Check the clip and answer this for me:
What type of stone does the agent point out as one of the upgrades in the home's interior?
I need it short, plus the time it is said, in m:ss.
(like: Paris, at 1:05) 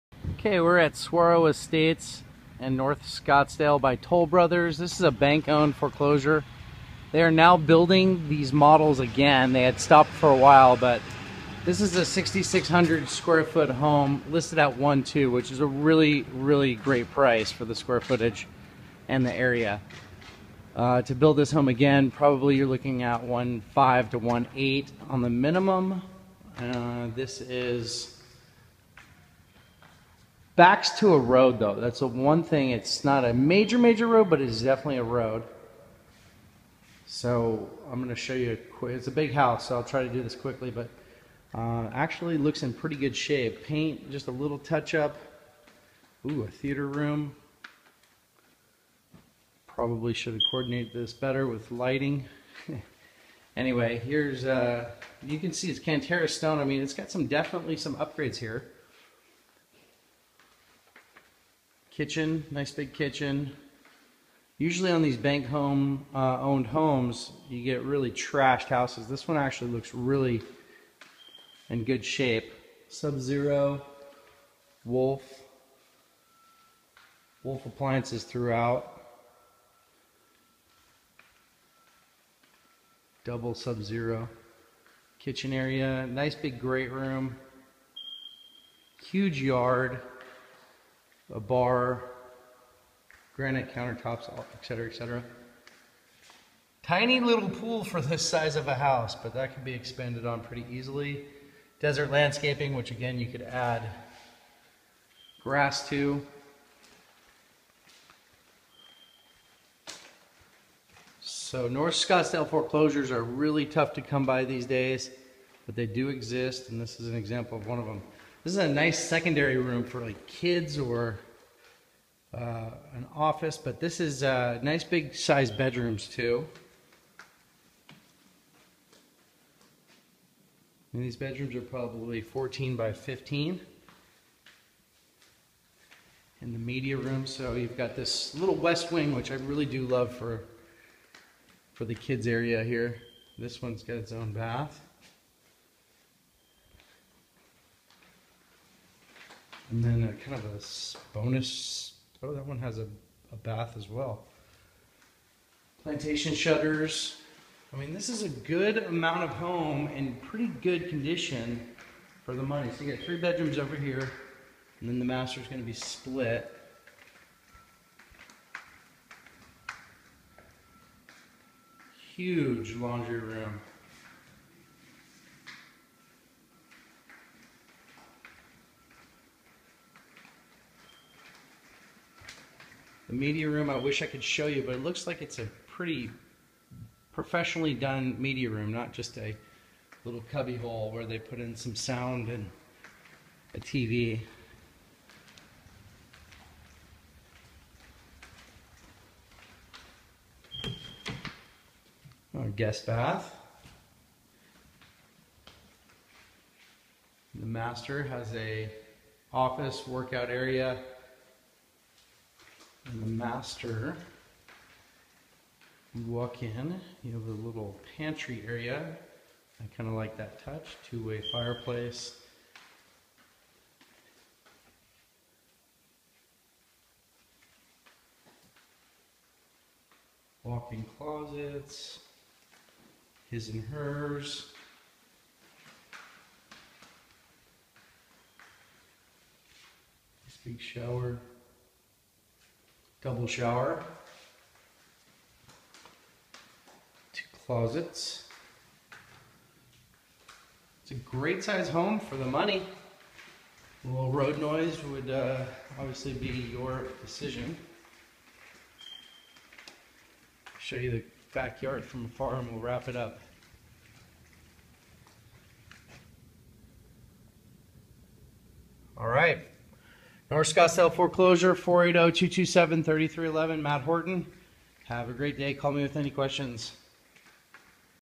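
Cantera stone, at 0:55.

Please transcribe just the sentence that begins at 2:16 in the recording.
In the media room, so you've got this little west wing, which I really do love for, for the kids area here.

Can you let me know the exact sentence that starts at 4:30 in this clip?
North Scottsdale foreclosure, 480-227-3311, Matt Horton.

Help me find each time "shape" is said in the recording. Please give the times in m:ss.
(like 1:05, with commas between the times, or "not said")
0:43, 1:12.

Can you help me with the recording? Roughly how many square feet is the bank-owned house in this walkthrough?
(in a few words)
6,600.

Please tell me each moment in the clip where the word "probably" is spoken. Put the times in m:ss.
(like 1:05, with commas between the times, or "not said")
0:22, 0:49, 2:11.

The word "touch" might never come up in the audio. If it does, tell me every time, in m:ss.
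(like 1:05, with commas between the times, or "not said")
0:44, 3:40.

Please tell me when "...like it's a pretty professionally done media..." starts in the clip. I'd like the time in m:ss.
3:05.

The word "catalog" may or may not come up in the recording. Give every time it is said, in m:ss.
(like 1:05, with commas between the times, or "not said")
not said.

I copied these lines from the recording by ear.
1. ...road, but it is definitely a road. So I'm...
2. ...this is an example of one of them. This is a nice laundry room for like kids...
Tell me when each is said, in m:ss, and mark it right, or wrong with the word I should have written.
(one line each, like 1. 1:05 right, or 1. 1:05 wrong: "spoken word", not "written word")
1. 0:34 right
2. 1:56 wrong: "secondary", not "laundry".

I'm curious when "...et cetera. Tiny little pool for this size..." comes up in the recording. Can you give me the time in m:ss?
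1:34.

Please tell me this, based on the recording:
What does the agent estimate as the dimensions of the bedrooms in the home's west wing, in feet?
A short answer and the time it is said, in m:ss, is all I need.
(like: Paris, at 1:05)
14 by 15, at 2:12.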